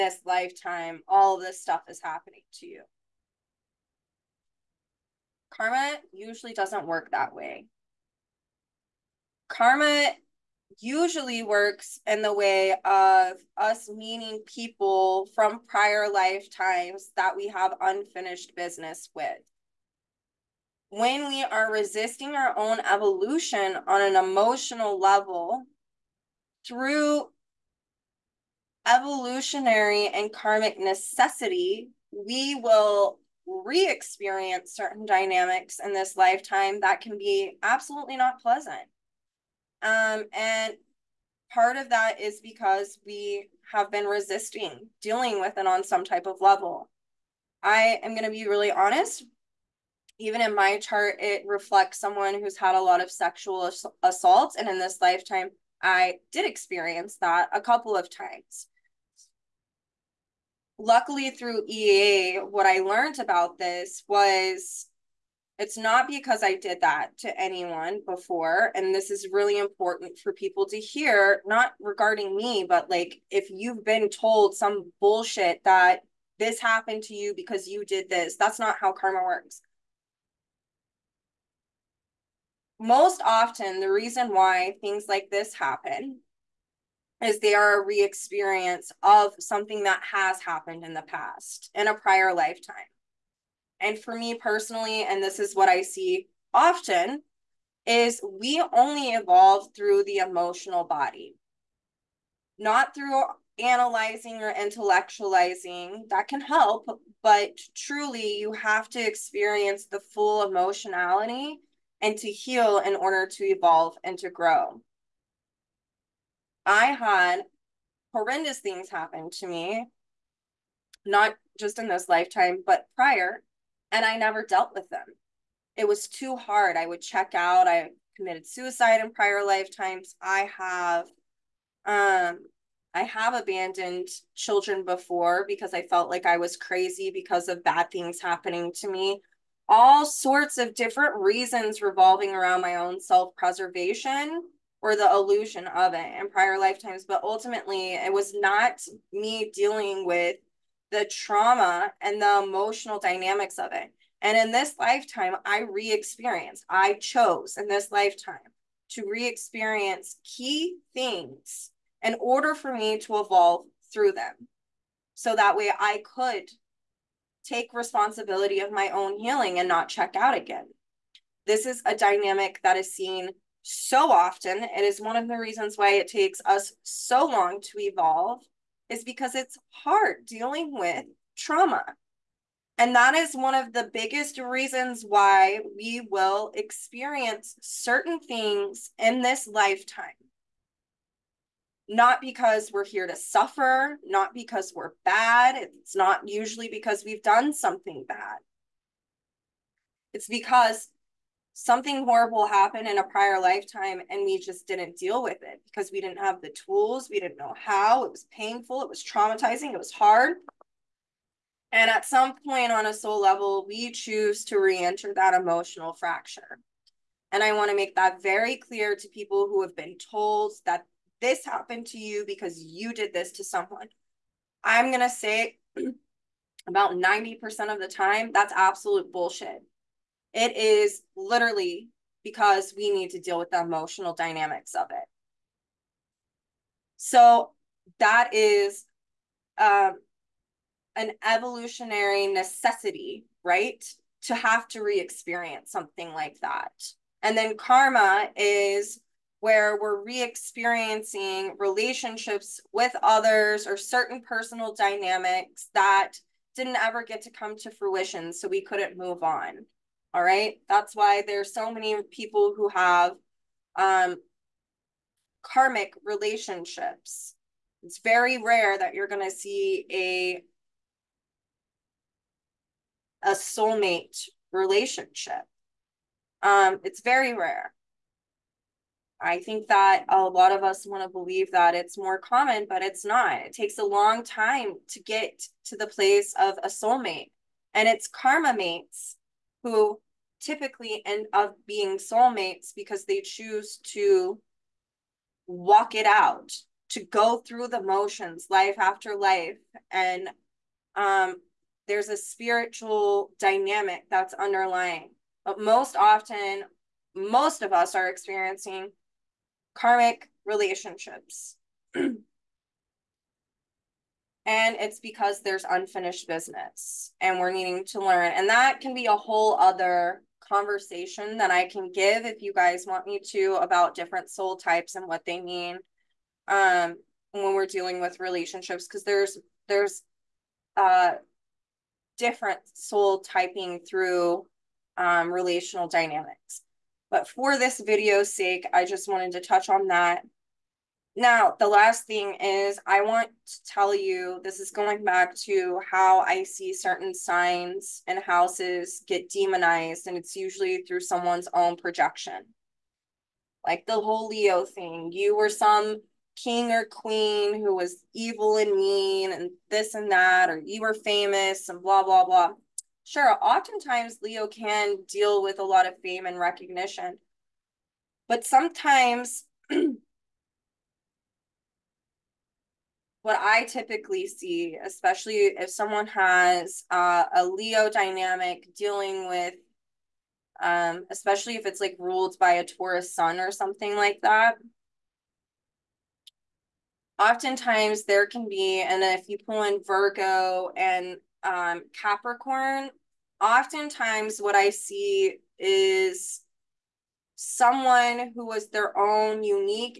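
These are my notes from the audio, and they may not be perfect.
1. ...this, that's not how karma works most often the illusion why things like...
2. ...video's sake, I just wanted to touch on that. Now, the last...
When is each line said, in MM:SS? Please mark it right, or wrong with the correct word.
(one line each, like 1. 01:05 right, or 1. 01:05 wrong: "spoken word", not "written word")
1. 01:18 wrong: "reason", not "illusion"
2. 05:37 right.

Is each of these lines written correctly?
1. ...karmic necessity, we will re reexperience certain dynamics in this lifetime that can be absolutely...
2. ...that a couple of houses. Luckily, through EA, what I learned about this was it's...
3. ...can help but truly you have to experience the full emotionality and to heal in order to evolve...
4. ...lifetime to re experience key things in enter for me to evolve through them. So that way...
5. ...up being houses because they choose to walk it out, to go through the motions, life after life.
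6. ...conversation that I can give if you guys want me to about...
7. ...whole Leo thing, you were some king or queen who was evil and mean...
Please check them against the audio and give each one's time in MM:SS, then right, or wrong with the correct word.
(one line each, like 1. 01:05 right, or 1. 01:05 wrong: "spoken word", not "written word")
1. 00:30 wrong: "experience", not "reexperience"
2. 00:57 wrong: "times", not "houses"
3. 01:46 right
4. 02:37 wrong: "order", not "enter"
5. 04:51 wrong: "soulmates", not "houses"
6. 05:20 right
7. 05:54 right.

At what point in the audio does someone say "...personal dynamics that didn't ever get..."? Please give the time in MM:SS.
04:14.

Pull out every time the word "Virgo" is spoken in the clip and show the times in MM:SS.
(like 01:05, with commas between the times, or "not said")
06:29.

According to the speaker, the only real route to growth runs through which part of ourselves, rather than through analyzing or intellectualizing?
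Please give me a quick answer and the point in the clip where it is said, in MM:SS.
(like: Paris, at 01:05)
the emotional body, at 01:40.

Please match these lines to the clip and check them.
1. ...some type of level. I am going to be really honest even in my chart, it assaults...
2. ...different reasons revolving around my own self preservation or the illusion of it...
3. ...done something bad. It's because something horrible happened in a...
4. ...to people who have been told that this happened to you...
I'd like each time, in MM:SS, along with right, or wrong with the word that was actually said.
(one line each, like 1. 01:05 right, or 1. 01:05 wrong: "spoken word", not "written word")
1. 00:45 wrong: "reflects", not "assaults"
2. 02:20 right
3. 03:17 right
4. 03:38 right.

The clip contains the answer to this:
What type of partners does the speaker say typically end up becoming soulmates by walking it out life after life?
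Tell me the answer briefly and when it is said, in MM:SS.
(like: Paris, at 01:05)
karma mates, at 04:48.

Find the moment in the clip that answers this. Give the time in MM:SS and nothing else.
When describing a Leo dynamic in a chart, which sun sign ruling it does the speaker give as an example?
06:22.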